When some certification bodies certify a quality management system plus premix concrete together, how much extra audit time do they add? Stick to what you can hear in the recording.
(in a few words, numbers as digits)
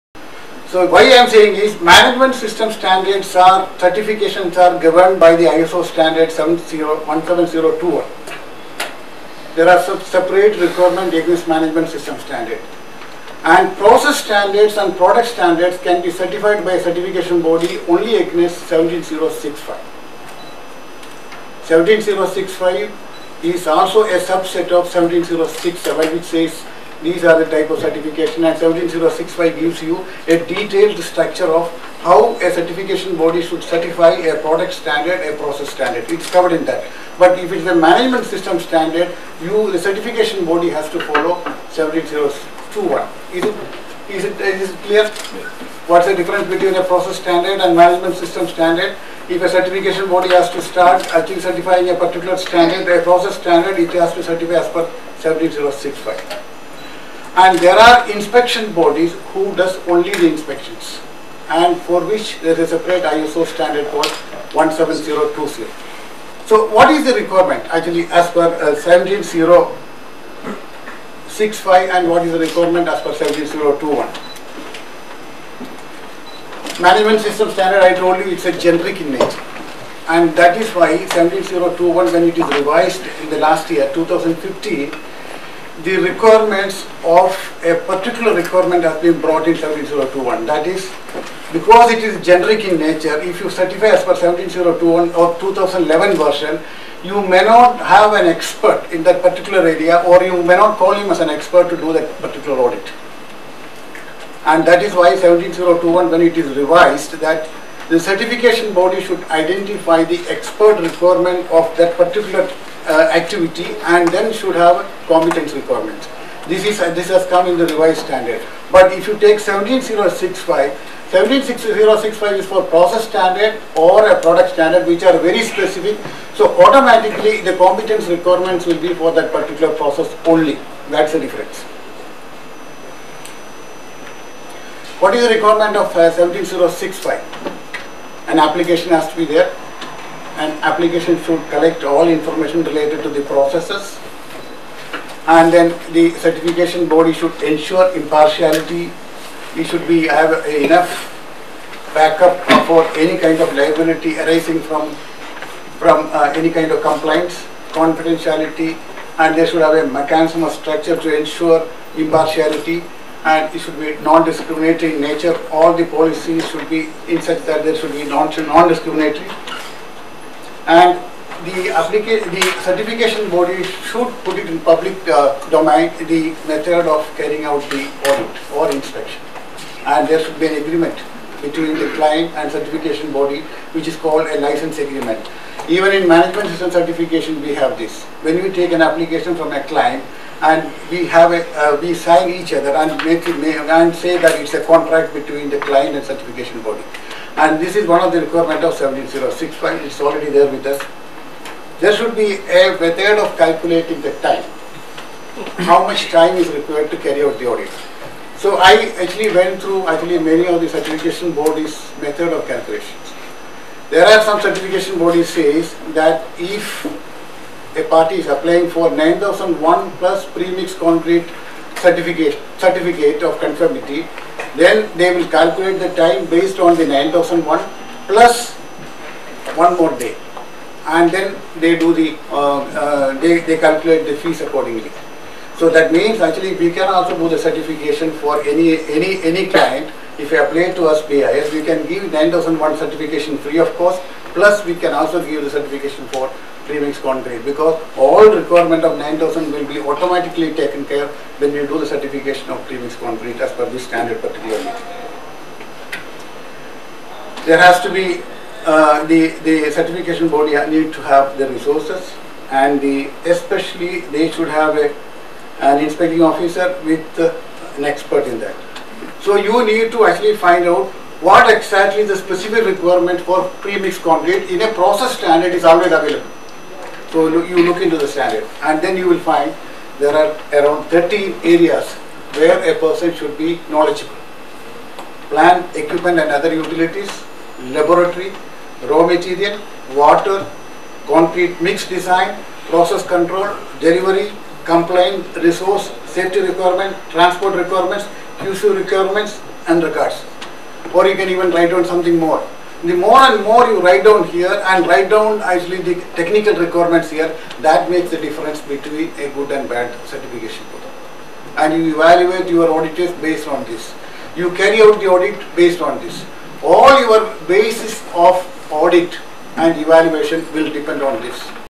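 One more day.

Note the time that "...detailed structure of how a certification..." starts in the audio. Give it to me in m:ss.
0:30.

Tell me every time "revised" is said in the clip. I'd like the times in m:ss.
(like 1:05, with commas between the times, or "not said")
1:22, 1:46, 1:57.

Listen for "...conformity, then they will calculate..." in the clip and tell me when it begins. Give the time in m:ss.
3:43.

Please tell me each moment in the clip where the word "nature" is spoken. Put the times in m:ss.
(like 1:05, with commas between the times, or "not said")
1:19, 1:32, 2:45.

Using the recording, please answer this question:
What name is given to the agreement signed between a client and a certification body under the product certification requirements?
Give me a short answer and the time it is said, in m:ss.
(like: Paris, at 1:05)
License agreement, at 3:04.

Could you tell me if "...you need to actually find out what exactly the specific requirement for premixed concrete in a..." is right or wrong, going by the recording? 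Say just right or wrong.
right.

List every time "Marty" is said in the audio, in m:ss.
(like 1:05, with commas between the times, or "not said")
not said.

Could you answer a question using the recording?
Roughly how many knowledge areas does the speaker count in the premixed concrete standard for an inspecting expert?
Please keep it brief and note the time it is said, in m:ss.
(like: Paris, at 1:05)
13, at 4:40.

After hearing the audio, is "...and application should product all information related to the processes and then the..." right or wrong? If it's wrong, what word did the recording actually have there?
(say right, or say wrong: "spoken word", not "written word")
wrong: "collect", not "product".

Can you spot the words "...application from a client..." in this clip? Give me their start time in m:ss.
3:08.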